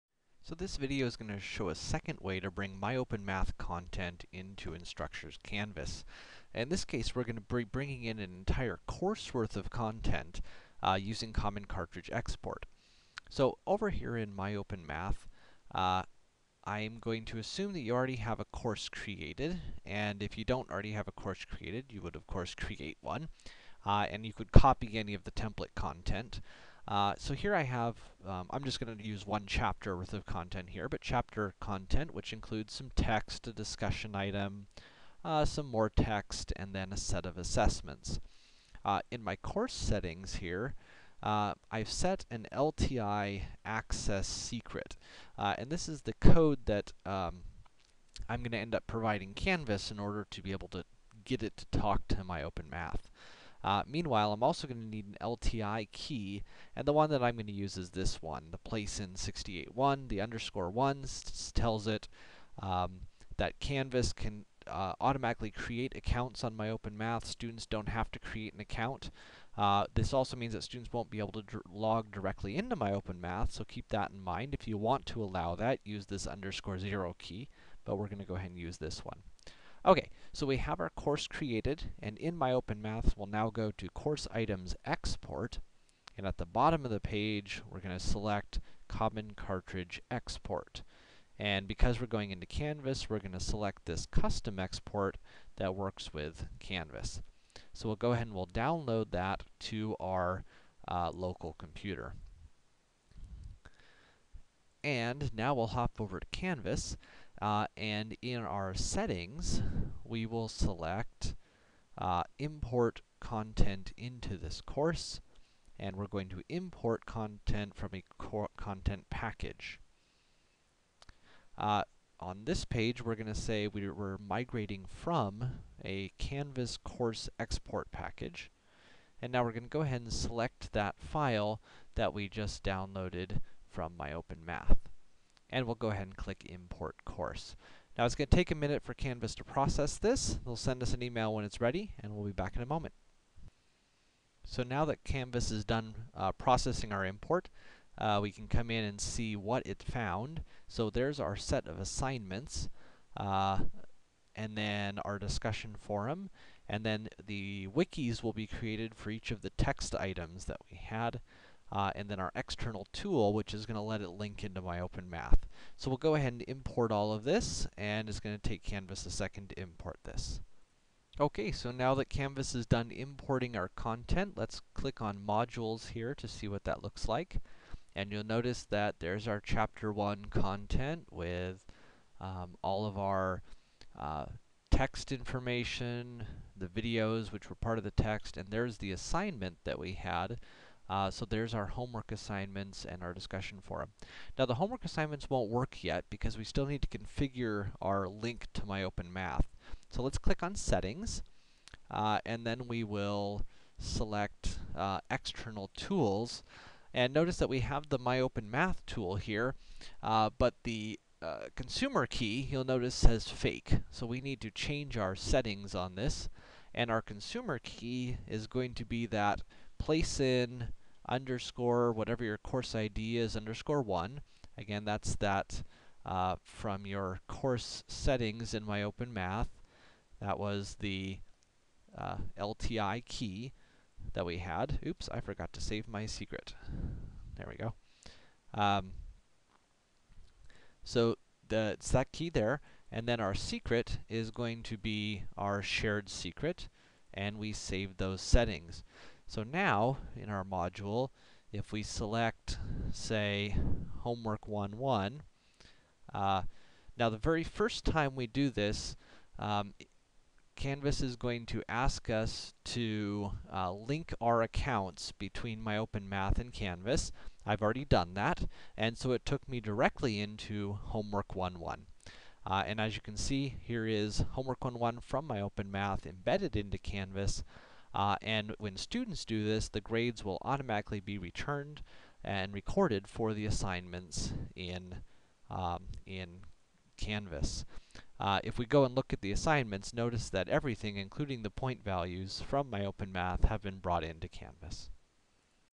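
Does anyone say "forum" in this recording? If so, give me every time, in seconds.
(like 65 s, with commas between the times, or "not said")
155 s, 193 s.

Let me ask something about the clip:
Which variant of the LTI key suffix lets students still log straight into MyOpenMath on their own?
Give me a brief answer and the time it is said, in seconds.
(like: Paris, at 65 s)
underscore zero, at 76 s.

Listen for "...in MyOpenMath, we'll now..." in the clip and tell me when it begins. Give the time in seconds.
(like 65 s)
82 s.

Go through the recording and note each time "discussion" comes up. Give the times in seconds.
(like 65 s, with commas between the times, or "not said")
33 s, 155 s, 193 s.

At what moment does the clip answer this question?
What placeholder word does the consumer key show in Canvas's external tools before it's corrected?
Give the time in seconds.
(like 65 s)
213 s.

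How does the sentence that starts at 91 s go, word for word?
And because we're going into Canvas, we're going to select this custom export that works with Canvas.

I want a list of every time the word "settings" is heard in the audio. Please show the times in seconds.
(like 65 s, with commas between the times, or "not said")
39 s, 108 s, 200 s, 215 s, 227 s, 248 s.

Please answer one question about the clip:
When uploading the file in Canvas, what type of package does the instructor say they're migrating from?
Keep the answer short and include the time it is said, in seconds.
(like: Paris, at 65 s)
Canvas course export package, at 126 s.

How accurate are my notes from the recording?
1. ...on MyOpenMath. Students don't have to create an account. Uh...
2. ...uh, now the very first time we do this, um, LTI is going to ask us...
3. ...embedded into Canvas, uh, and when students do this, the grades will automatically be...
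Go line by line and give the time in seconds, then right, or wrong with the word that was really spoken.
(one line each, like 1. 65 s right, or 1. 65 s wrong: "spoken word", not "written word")
1. 66 s right
2. 256 s wrong: "Canvas", not "LTI"
3. 276 s right.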